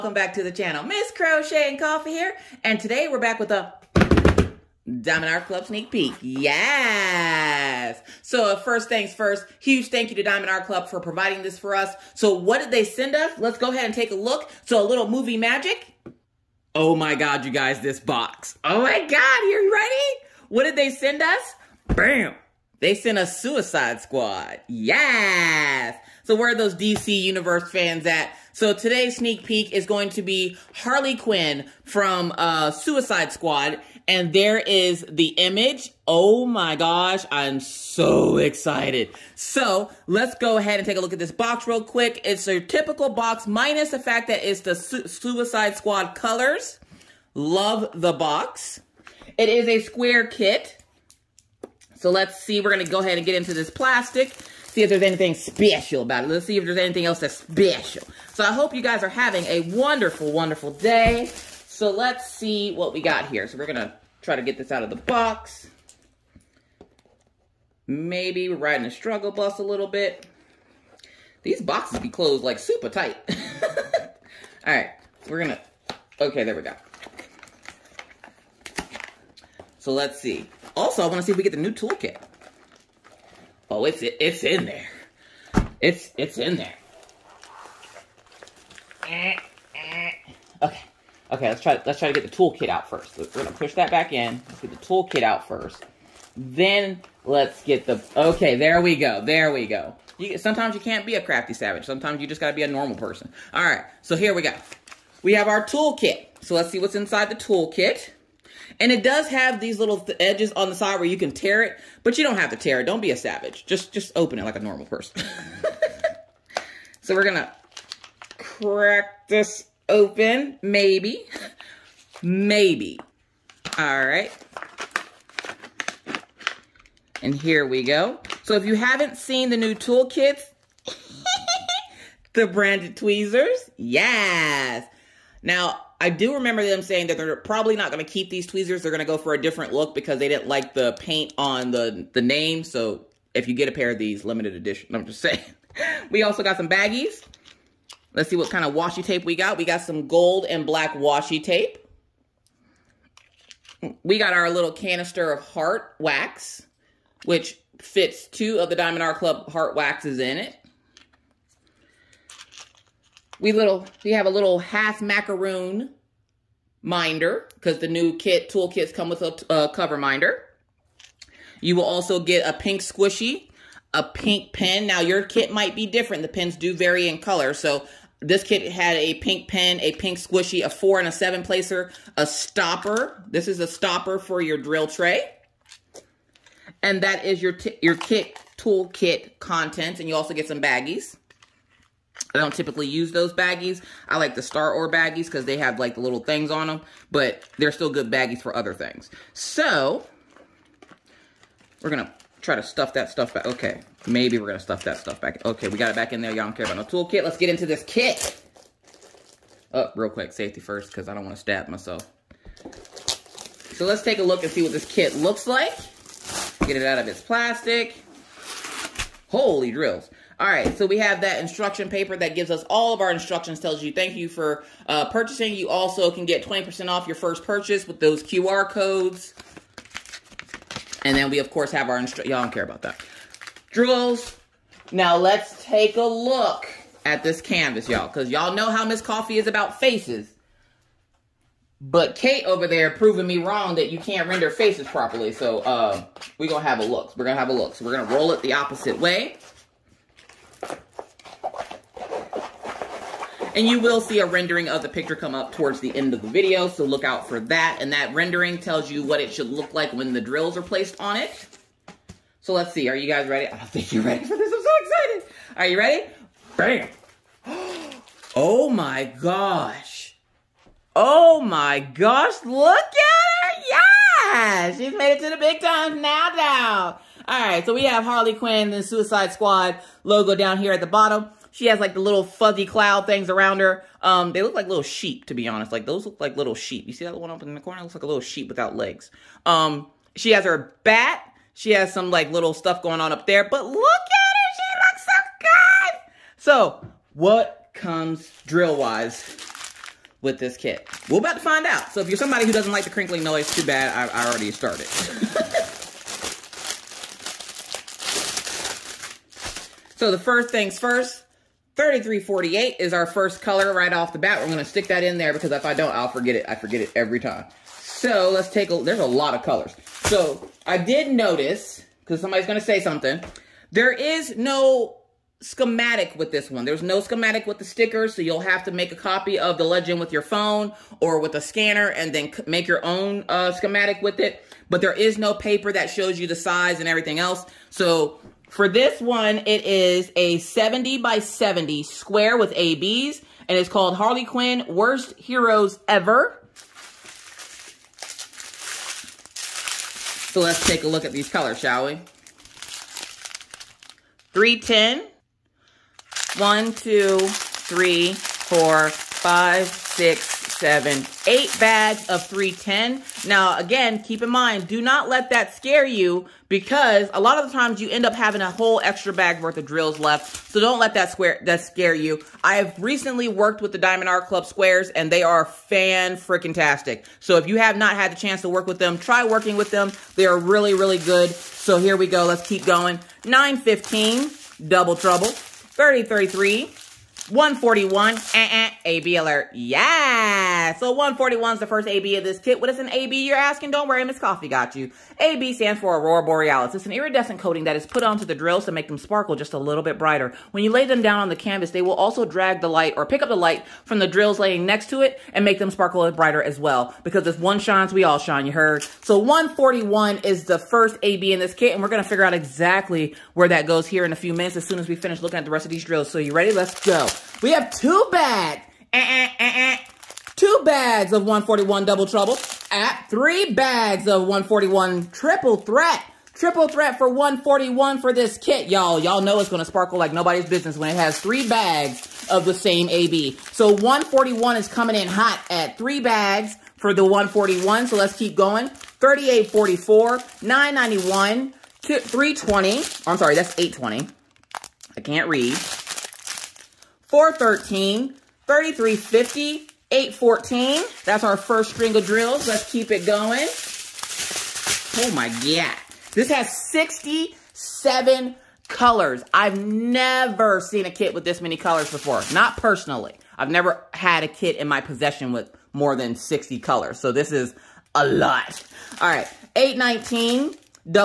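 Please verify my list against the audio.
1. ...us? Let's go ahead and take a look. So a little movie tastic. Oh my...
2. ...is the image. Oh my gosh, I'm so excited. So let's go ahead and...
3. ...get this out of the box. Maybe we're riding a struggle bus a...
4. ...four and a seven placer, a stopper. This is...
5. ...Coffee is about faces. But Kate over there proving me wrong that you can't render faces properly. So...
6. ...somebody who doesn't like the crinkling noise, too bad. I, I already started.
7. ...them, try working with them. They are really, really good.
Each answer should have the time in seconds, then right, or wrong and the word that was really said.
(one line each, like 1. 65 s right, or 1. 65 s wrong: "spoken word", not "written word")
1. 13 s wrong: "magic", not "tastic"
2. 34 s right
3. 64 s right
4. 180 s right
5. 238 s right
6. 302 s right
7. 378 s right.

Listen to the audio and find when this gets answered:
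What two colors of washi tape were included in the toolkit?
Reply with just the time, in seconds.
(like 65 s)
150 s.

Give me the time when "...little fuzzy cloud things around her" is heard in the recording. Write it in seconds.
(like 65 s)
281 s.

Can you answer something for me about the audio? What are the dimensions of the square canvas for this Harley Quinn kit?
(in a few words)
70 by 70.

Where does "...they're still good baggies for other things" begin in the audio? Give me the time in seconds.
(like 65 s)
197 s.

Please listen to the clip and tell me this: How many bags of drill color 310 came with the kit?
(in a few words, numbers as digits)
8.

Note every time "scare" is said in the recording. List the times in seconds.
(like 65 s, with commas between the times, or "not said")
365 s, 371 s.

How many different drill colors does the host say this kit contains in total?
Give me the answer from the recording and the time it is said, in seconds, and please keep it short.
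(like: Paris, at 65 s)
67, at 456 s.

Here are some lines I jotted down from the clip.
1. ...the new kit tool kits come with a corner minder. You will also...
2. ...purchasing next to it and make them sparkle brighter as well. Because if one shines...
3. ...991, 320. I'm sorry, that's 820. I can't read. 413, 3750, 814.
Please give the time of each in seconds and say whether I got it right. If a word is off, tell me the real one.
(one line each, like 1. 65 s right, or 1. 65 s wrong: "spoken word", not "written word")
1. 167 s wrong: "cover", not "corner"
2. 404 s wrong: "laying", not "purchasing"
3. 440 s wrong: "3350", not "3750".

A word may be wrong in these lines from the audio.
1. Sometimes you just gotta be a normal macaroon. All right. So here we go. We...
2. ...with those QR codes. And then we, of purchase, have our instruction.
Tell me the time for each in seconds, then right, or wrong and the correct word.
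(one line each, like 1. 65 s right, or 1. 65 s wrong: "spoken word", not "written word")
1. 101 s wrong: "person", not "macaroon"
2. 227 s wrong: "course", not "purchase".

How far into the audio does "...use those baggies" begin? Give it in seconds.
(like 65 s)
192 s.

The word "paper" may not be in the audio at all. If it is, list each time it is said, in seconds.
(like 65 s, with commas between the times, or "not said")
221 s, 335 s.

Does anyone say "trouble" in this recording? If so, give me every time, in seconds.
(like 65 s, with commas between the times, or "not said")
384 s, 422 s.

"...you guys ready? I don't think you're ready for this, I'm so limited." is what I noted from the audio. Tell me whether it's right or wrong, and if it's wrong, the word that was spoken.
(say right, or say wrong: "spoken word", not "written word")
wrong: "excited", not "limited".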